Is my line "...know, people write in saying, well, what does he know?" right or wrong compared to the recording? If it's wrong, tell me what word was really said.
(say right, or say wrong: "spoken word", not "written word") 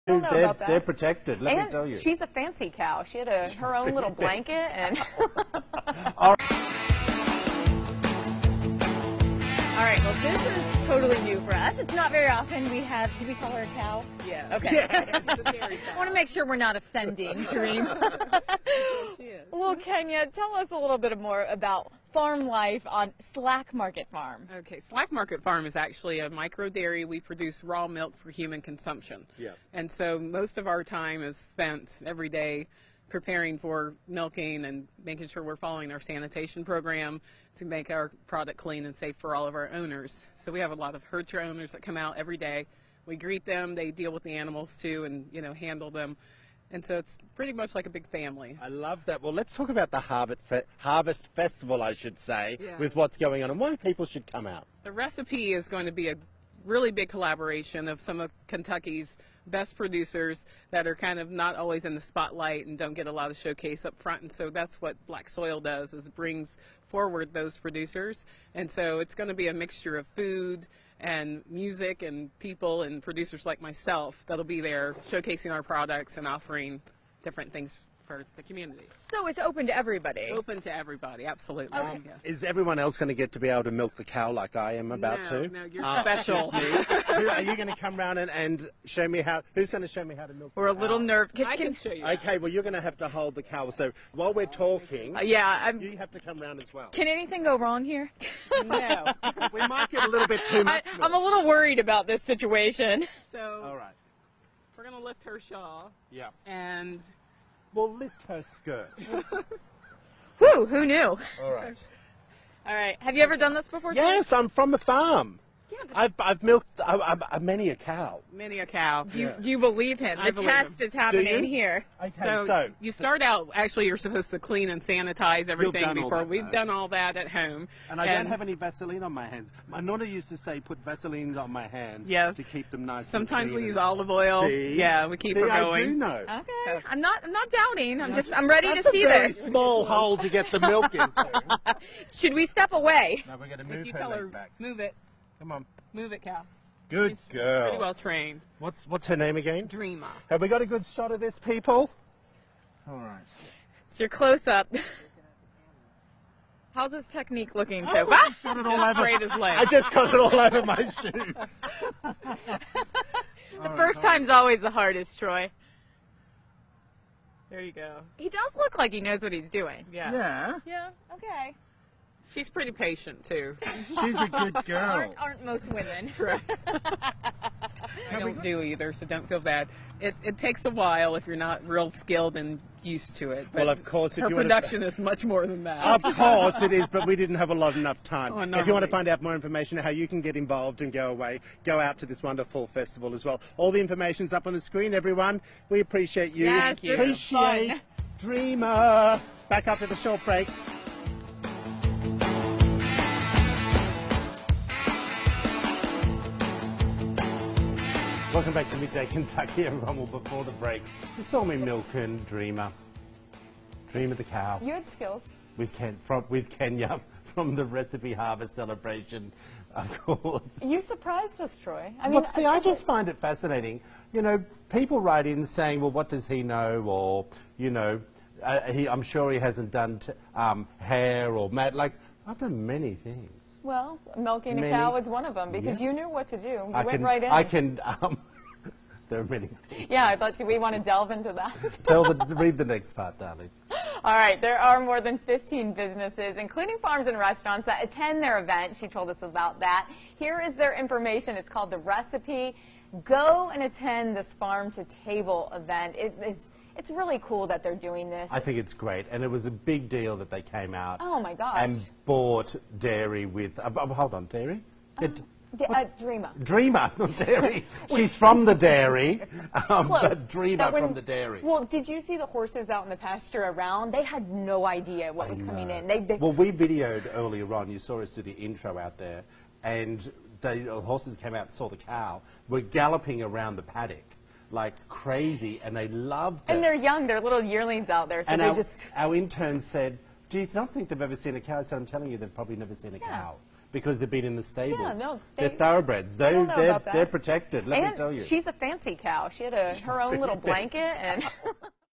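right.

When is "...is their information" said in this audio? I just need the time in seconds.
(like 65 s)
250 s.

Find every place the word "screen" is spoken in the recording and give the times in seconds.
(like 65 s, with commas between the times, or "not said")
194 s.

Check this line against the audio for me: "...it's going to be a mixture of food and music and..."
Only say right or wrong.
right.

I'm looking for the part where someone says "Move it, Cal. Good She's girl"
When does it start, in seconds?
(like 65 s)
145 s.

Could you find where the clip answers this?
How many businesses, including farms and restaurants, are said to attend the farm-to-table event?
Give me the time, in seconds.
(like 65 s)
244 s.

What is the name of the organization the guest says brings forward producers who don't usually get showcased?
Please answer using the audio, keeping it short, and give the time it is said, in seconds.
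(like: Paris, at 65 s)
Black Soil, at 65 s.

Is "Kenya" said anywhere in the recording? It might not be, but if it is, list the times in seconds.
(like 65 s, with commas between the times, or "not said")
19 s, 216 s.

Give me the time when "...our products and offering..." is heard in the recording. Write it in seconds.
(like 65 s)
75 s.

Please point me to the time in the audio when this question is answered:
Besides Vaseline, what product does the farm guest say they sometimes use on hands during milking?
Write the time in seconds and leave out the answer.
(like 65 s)
133 s.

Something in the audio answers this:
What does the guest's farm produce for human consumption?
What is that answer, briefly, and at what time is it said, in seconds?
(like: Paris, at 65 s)
Raw milk, at 27 s.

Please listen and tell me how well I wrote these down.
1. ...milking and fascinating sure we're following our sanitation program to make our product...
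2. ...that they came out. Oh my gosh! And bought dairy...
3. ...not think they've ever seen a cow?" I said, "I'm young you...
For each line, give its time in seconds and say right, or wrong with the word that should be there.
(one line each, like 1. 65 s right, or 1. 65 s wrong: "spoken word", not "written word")
1. 34 s wrong: "making", not "fascinating"
2. 260 s right
3. 290 s wrong: "telling", not "young".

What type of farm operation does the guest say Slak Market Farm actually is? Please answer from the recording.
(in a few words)
Micro dairy.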